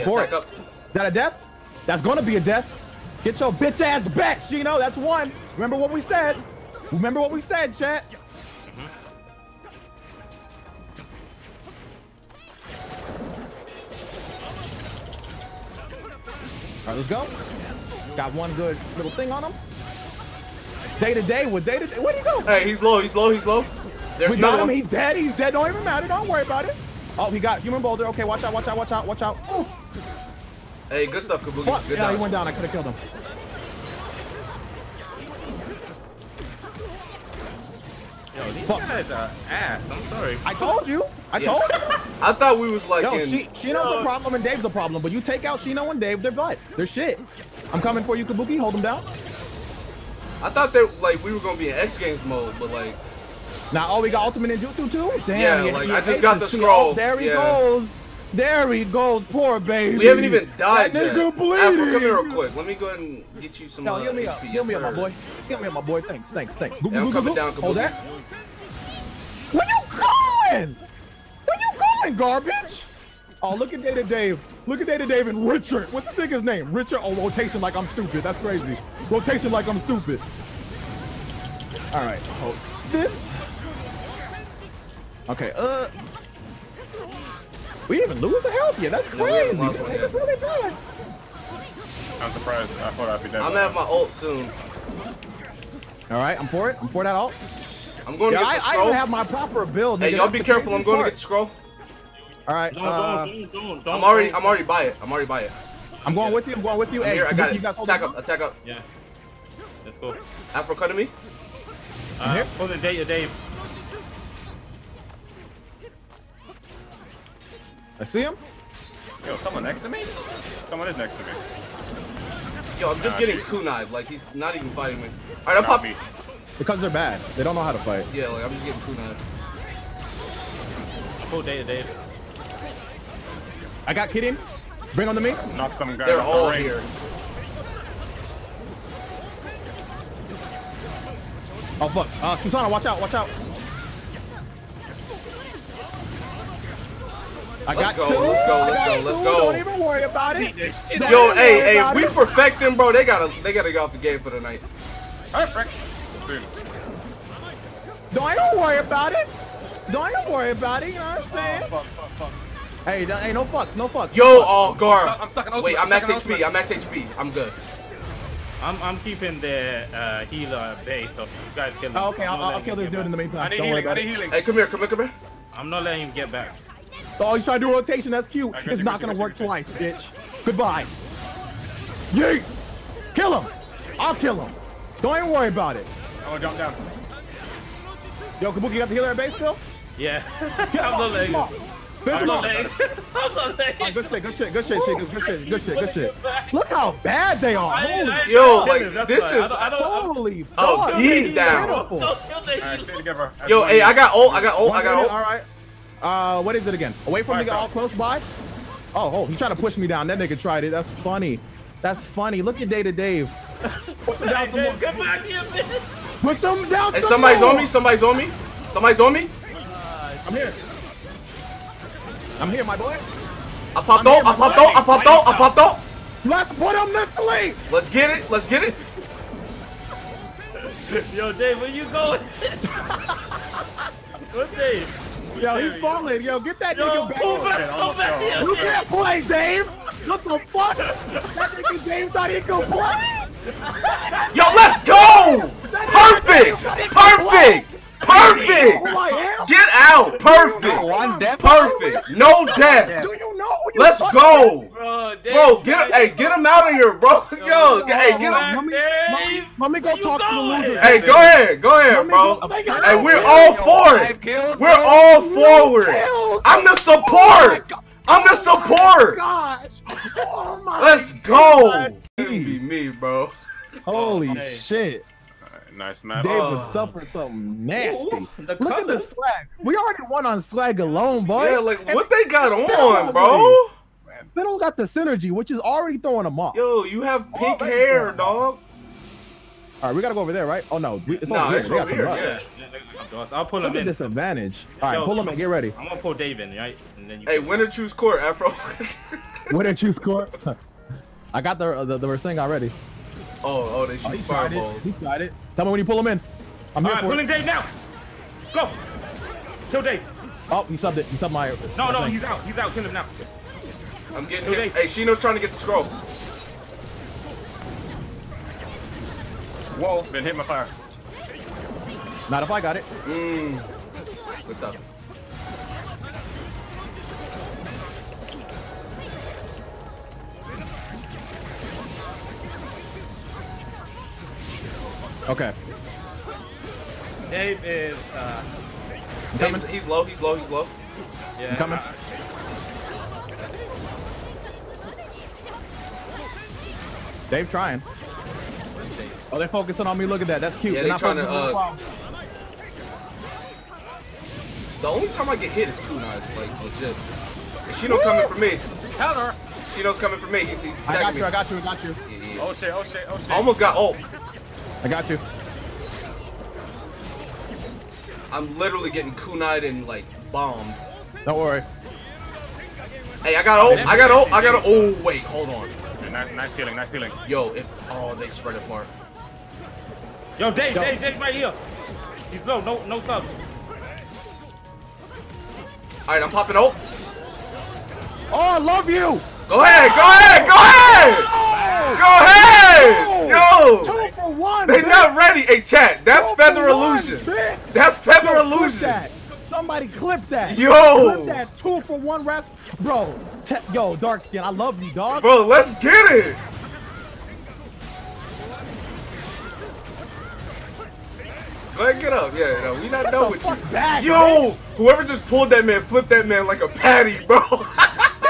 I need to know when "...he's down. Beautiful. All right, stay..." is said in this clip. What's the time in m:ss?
3:20.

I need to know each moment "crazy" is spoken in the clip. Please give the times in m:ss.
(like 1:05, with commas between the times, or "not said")
1:18, 1:29.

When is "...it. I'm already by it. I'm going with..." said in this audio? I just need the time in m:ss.
1:44.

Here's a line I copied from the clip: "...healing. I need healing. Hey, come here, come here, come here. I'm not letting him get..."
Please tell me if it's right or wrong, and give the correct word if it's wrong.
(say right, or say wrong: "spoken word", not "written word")
right.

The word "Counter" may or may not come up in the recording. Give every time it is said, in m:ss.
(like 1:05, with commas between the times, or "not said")
5:58.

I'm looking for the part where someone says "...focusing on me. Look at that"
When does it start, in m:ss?
5:49.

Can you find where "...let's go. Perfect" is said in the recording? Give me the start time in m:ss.
4:04.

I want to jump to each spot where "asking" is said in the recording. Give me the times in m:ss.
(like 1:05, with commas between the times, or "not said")
not said.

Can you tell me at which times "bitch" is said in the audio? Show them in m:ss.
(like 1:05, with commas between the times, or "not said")
0:03, 2:59.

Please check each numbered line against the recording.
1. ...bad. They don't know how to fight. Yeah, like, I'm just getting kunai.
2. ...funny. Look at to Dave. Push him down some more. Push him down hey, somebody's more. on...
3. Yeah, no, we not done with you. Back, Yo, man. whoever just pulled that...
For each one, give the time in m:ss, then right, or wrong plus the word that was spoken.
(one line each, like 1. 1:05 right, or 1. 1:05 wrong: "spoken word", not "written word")
1. 2:06 right
2. 3:32 right
3. 6:52 right.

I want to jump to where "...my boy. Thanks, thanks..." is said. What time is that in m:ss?
1:05.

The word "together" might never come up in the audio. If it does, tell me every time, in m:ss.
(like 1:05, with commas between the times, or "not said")
3:22.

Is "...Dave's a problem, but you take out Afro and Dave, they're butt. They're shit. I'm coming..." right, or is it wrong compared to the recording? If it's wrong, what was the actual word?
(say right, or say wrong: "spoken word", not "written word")
wrong: "Shino", not "Afro".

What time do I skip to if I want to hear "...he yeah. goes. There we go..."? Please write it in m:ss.
0:57.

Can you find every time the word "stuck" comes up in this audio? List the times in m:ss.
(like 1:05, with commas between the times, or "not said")
2:45.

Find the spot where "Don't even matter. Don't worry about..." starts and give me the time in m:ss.
0:25.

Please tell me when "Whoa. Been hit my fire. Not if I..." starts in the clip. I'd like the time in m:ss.
5:19.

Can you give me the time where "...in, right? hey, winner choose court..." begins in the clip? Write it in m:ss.
4:56.